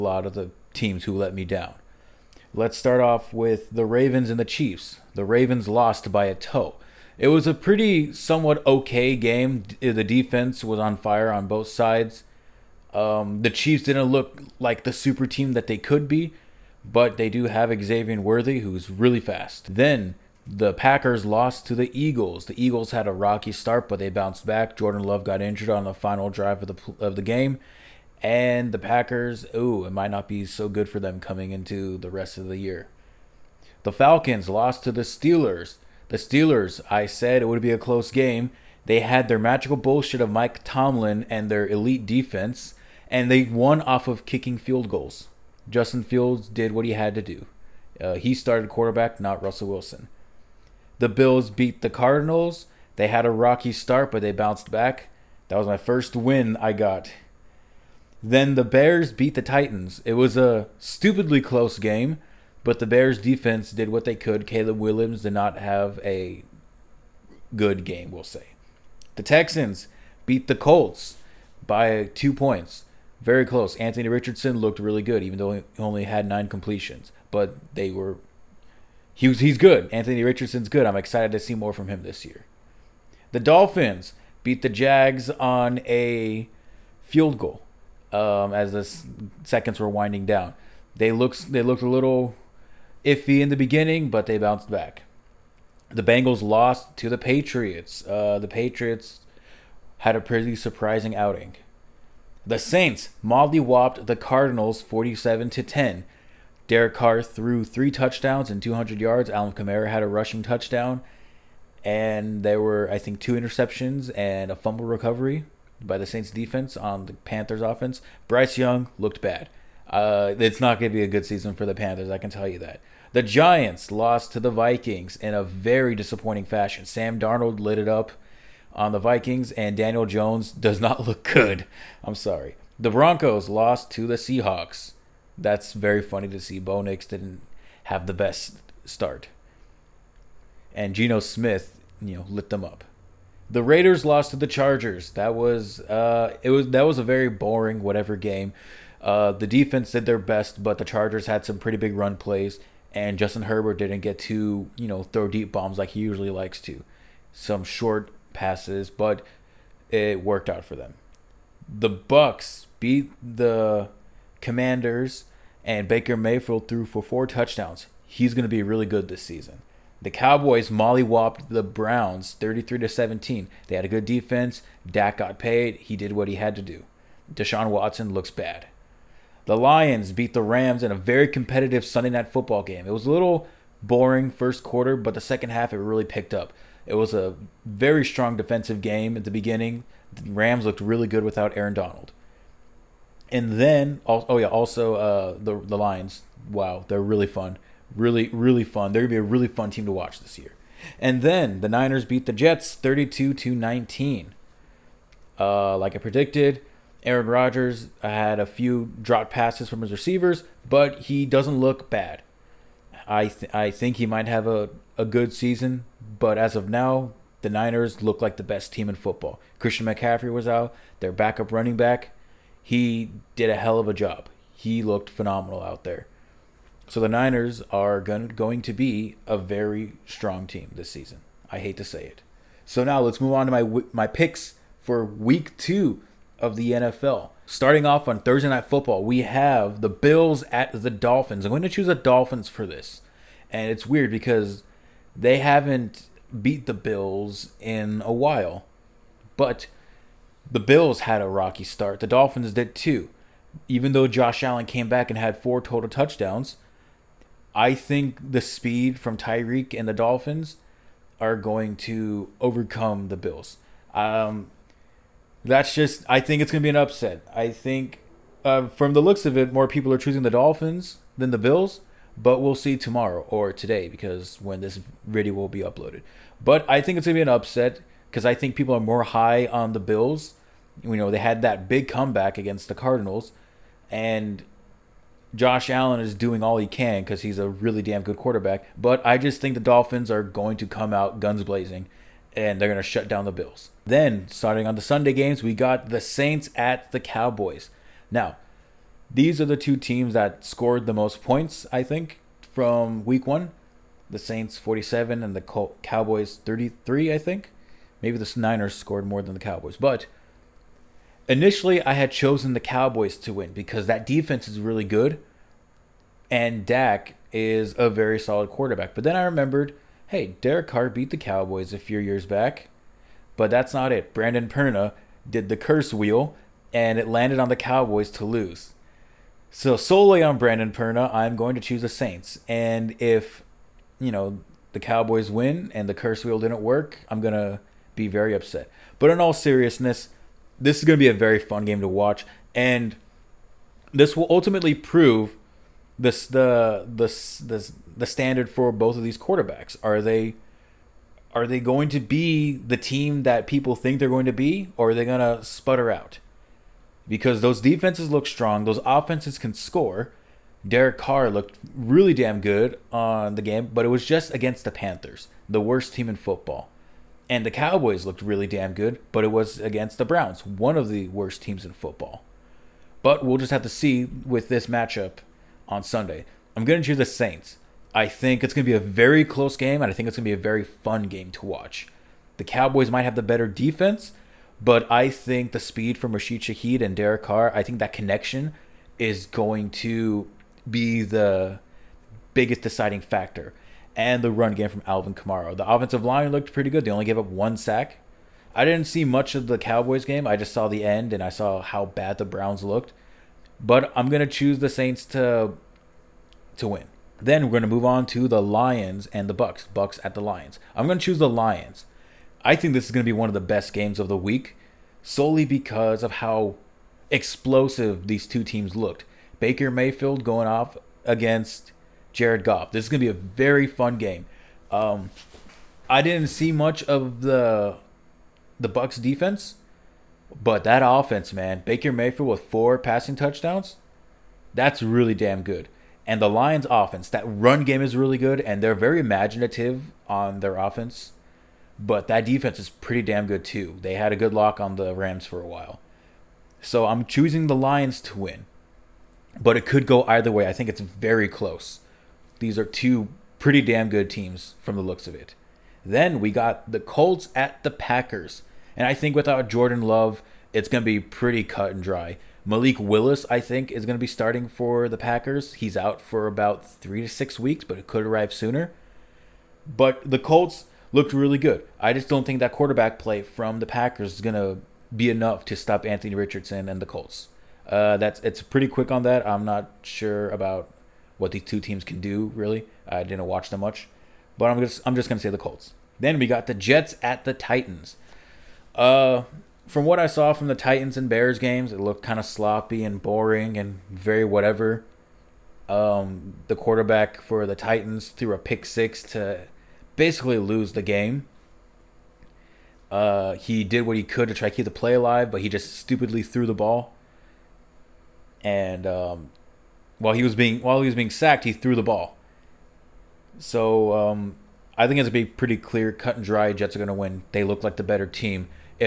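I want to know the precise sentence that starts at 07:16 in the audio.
And the Lions offense, that run game is really good and they're very imaginative on their offense.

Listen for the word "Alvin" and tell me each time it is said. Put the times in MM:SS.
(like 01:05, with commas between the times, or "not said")
01:49, 06:34.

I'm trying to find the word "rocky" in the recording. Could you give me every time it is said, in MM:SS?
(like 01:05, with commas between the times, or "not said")
00:23, 00:53, 04:11.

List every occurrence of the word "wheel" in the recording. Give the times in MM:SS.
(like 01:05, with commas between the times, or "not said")
05:25, 05:36.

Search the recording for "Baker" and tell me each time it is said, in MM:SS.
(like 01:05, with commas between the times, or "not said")
02:45, 06:59, 07:11.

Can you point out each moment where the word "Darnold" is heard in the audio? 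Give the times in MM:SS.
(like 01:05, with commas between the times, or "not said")
02:07.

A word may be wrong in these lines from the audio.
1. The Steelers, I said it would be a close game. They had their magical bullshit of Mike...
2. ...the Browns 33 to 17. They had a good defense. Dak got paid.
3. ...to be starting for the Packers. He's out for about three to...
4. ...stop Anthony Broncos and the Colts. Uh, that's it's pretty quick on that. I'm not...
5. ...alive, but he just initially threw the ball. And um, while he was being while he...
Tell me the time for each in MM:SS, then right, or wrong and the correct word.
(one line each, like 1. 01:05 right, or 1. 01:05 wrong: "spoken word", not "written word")
1. 00:36 right
2. 02:51 right
3. 07:43 right
4. 07:55 wrong: "Richardson", not "Broncos"
5. 08:24 wrong: "stupidly", not "initially".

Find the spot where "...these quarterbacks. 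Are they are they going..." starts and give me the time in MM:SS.
05:49.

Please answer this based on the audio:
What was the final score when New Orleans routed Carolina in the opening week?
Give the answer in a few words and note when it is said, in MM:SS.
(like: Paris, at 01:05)
47 to 10, at 01:44.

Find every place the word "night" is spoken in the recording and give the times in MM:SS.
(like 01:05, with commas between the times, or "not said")
03:02, 03:58.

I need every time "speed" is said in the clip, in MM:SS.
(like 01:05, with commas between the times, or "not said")
04:18, 06:25.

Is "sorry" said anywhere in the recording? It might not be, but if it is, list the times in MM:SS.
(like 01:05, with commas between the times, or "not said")
02:12.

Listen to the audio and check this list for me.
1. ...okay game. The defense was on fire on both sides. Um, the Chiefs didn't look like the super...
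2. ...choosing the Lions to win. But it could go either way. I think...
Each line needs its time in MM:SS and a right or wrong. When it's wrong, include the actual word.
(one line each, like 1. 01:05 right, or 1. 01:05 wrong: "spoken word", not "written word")
1. 00:08 right
2. 07:27 right.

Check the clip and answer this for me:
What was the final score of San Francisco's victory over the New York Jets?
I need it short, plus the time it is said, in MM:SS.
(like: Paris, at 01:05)
32 to 19, at 03:22.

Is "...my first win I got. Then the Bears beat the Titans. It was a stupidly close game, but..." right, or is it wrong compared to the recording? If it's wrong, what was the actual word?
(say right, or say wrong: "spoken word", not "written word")
right.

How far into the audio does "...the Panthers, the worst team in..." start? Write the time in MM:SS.
06:04.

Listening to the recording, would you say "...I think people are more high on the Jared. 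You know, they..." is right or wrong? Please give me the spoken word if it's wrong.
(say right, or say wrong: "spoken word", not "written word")
wrong: "Bills", not "Jared".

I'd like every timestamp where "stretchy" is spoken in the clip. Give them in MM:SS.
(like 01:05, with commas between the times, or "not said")
not said.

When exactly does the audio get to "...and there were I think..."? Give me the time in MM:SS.
01:51.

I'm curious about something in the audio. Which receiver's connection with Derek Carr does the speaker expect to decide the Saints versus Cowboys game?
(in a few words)
Rashid Shaheed.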